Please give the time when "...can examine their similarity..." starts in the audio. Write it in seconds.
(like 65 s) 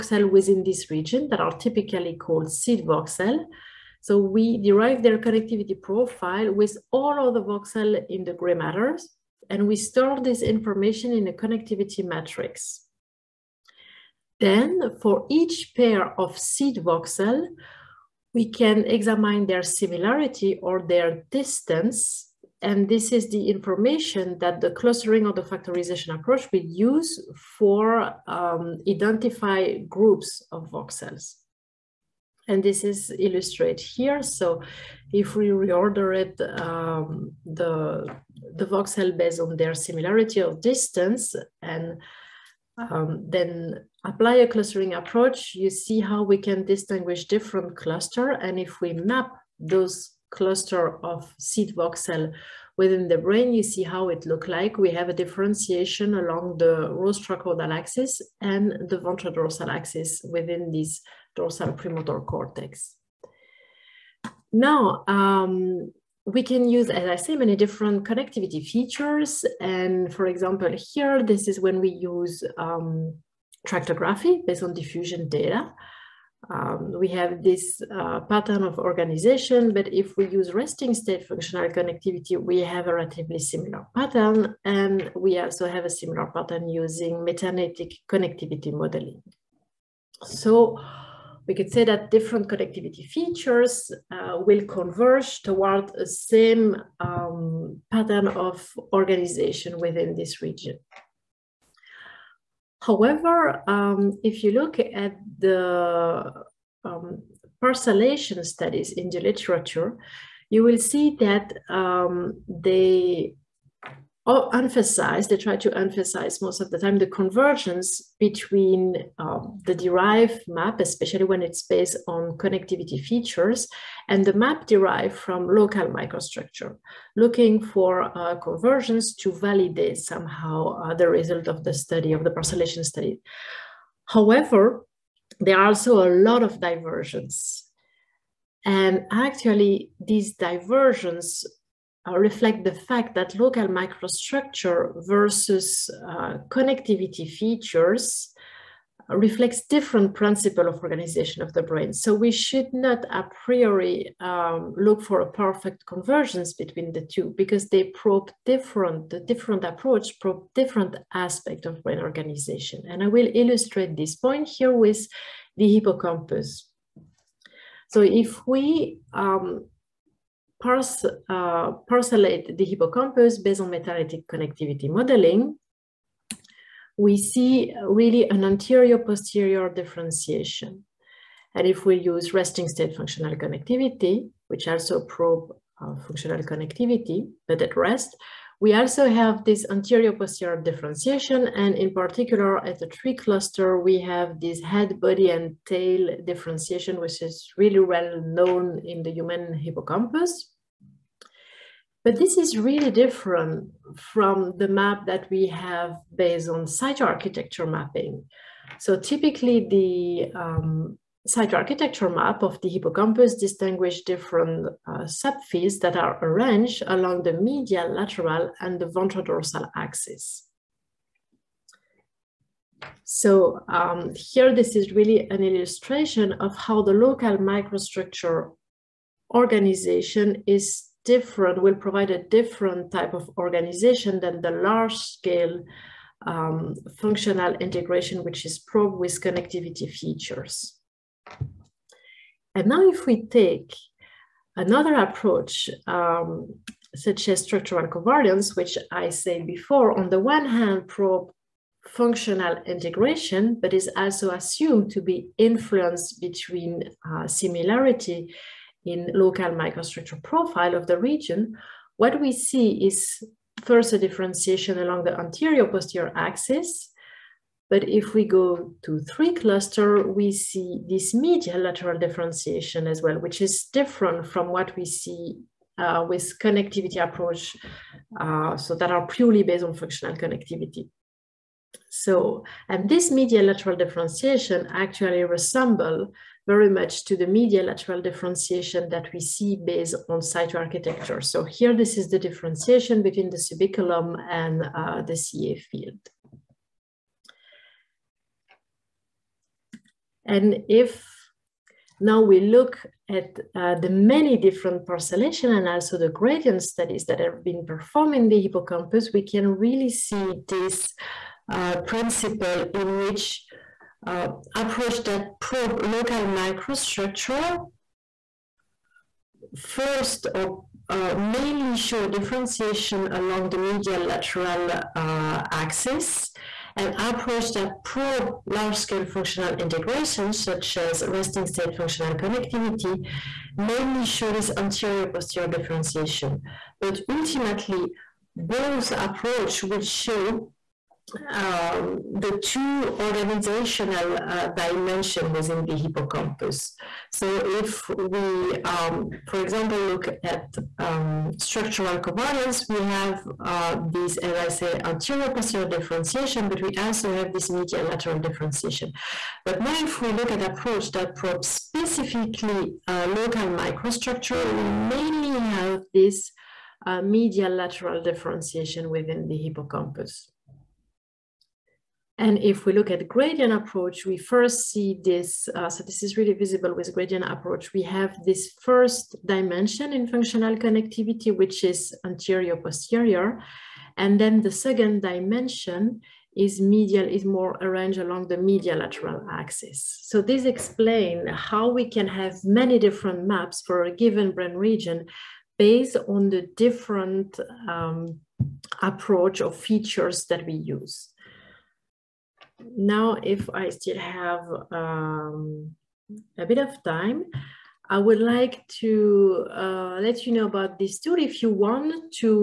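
18 s.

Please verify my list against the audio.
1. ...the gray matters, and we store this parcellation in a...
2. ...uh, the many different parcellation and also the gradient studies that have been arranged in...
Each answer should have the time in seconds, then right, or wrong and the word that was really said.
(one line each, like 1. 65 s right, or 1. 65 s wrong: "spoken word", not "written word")
1. 8 s wrong: "information", not "parcellation"
2. 303 s wrong: "performed", not "arranged".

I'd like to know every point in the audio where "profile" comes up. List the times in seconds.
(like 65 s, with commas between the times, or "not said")
5 s, 260 s.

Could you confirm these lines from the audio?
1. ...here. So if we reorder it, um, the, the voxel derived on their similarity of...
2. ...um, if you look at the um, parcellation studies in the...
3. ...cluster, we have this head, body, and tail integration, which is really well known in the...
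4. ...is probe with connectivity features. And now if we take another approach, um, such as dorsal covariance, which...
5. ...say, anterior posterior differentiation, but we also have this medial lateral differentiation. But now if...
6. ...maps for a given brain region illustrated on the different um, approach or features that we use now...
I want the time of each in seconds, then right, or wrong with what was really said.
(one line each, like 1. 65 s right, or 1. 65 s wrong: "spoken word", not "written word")
1. 33 s wrong: "based", not "derived"
2. 103 s right
3. 193 s wrong: "differentiation", not "integration"
4. 238 s wrong: "structural", not "dorsal"
5. 354 s right
6. 393 s wrong: "based", not "illustrated".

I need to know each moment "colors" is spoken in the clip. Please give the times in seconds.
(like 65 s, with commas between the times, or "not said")
not said.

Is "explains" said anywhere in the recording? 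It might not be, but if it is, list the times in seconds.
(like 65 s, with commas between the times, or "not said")
390 s.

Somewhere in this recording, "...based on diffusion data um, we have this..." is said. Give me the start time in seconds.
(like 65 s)
74 s.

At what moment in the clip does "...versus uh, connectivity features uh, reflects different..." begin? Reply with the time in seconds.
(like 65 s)
145 s.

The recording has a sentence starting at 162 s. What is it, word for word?
And I will illustrate this point here with the hippocampus.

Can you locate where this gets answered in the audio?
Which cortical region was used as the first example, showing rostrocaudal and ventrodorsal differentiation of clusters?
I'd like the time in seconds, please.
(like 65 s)
61 s.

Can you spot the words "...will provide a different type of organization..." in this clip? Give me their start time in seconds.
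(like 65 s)
231 s.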